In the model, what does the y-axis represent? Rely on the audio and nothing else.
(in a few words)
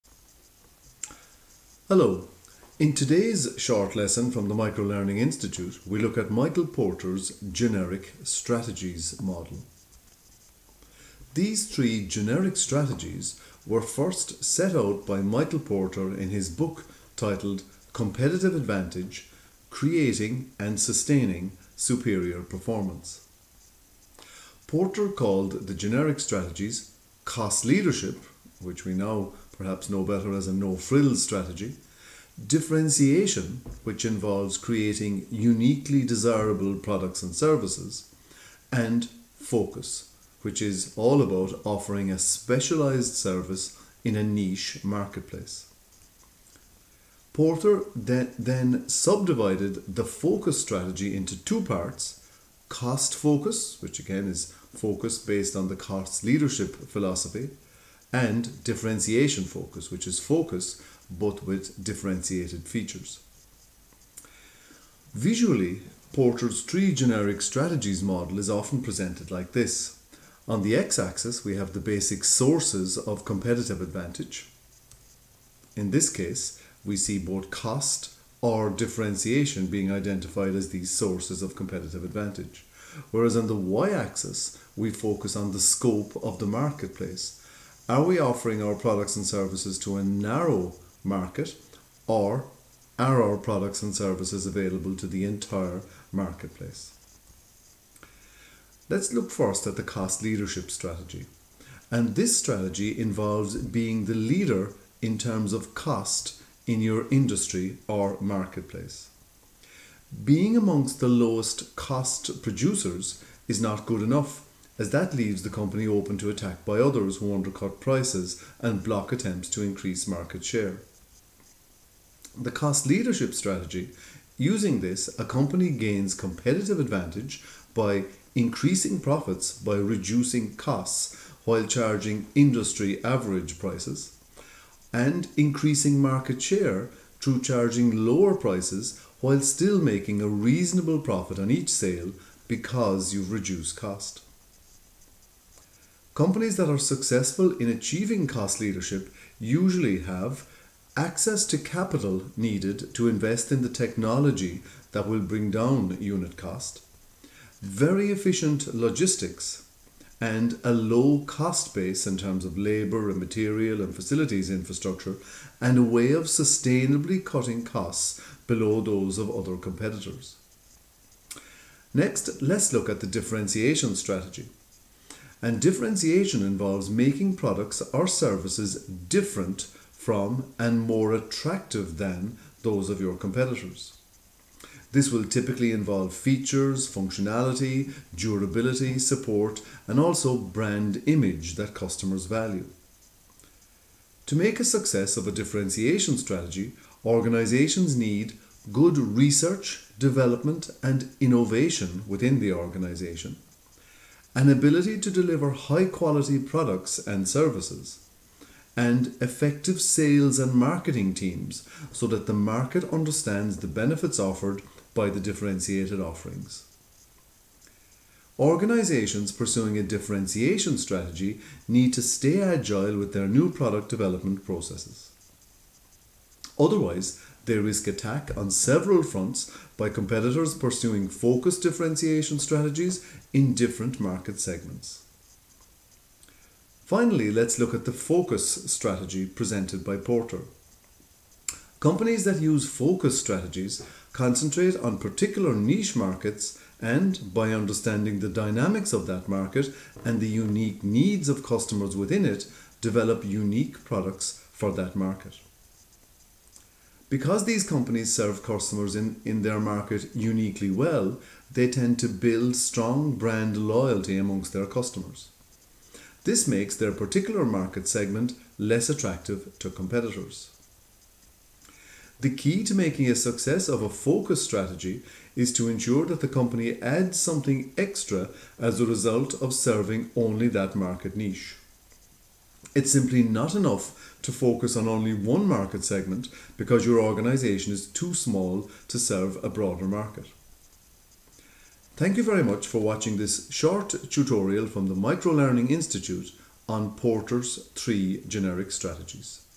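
scope of the marketplace.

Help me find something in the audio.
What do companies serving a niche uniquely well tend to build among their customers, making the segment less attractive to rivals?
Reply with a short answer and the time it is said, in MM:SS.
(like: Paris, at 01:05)
strong brand loyalty, at 04:22.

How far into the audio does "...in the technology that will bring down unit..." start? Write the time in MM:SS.
02:33.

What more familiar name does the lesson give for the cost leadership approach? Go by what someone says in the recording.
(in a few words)
no frills strategy.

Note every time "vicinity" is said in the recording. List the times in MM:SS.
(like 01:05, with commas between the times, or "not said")
not said.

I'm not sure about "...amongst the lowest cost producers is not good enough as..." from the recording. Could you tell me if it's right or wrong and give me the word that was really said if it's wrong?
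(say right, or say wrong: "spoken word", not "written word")
right.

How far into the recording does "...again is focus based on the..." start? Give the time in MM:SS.
00:53.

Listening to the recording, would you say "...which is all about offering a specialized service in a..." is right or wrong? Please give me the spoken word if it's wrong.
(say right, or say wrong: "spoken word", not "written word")
right.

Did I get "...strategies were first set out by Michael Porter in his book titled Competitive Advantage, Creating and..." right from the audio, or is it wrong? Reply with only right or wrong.
right.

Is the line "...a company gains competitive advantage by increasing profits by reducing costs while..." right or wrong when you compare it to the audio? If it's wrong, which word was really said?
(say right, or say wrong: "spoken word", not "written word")
right.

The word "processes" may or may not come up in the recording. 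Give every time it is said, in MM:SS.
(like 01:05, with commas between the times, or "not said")
03:44.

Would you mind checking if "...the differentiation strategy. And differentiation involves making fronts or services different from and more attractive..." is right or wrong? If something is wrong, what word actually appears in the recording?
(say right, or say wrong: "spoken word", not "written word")
wrong: "products", not "fronts".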